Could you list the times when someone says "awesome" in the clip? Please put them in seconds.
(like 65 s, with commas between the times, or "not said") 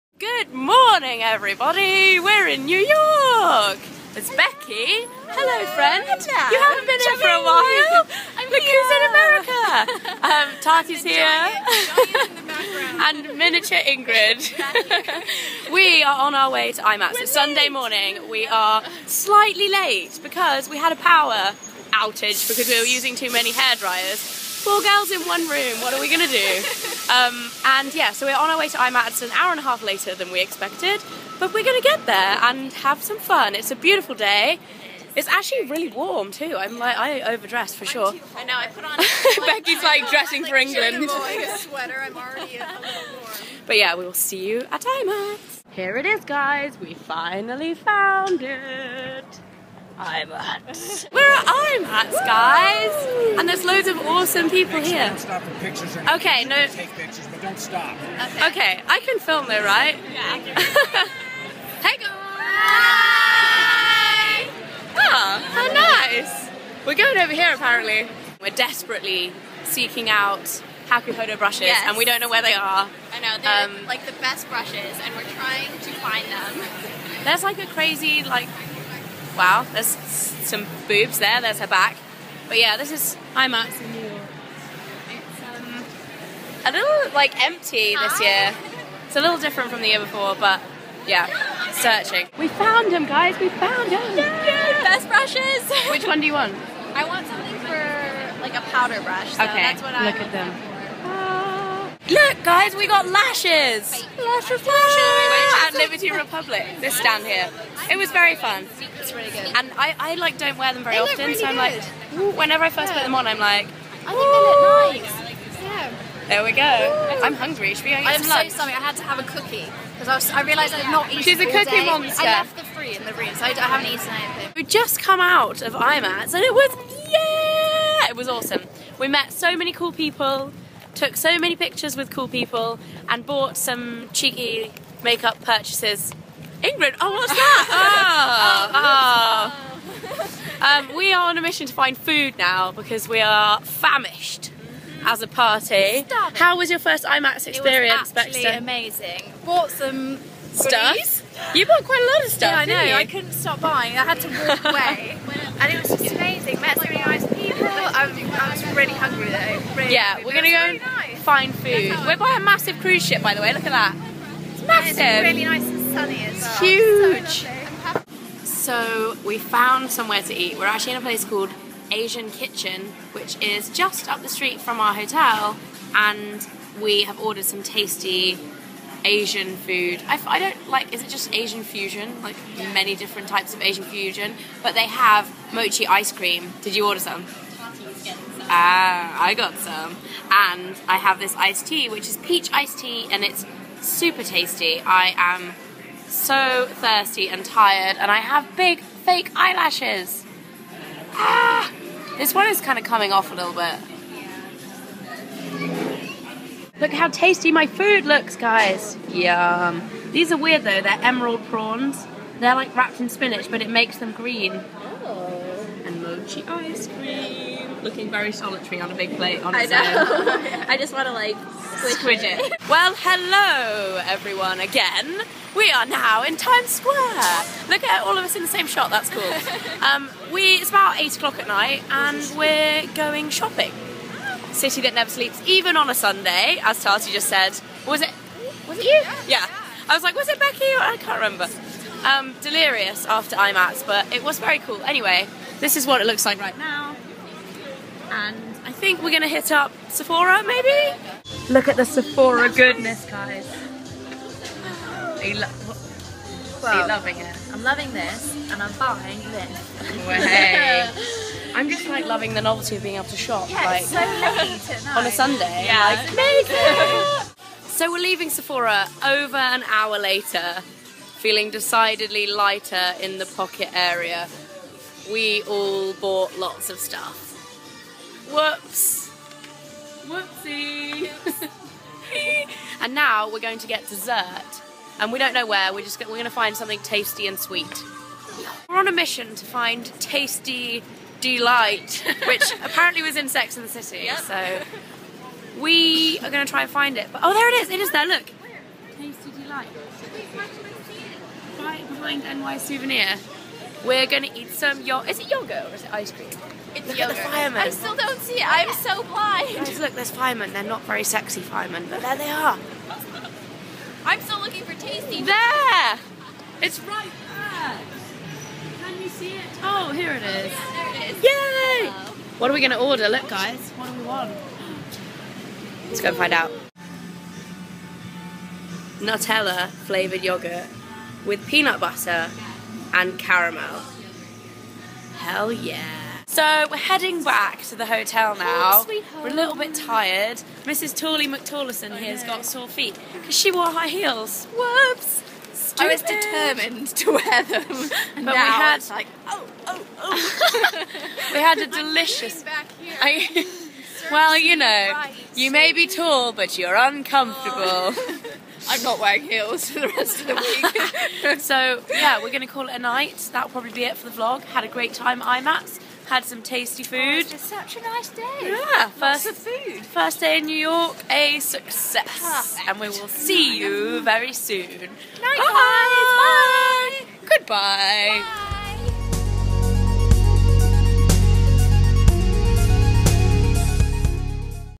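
54 s, 128 s.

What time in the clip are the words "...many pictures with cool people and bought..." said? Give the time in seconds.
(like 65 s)
131 s.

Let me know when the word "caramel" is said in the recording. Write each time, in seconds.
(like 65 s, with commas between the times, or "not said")
333 s.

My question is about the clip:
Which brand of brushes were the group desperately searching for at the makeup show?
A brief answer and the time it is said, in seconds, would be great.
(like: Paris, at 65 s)
Hakuhodo, at 70 s.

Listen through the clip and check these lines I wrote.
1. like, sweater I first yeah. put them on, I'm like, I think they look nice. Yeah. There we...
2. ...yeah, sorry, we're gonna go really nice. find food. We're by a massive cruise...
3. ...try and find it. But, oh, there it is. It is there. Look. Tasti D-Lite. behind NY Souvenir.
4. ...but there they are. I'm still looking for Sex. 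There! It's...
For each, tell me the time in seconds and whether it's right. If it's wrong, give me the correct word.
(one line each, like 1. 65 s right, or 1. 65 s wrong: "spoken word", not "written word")
1. 112 s wrong: "whenever", not "sweater"
2. 159 s wrong: "hungry", not "sorry"
3. 296 s right
4. 311 s wrong: "Tasti", not "Sex".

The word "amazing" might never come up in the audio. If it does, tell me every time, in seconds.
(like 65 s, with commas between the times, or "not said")
148 s, 156 s.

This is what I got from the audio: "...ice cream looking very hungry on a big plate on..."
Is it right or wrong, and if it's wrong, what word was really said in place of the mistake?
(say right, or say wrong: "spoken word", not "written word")
wrong: "solitary", not "hungry".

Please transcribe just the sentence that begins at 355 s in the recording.
you may be tall, but you're uncomfortable.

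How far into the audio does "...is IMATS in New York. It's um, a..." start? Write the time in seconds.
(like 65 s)
82 s.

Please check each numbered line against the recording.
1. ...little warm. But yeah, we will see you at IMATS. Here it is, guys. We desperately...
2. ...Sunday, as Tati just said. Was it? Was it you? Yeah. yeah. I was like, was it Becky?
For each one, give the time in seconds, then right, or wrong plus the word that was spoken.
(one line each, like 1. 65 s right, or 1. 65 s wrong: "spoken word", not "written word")
1. 42 s wrong: "finally", not "desperately"
2. 235 s right.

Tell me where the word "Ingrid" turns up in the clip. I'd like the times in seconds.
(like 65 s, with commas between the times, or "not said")
13 s, 136 s.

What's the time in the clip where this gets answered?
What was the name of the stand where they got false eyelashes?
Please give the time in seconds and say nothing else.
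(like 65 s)
105 s.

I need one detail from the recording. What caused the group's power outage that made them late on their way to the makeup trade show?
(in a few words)
Too many hair dryers.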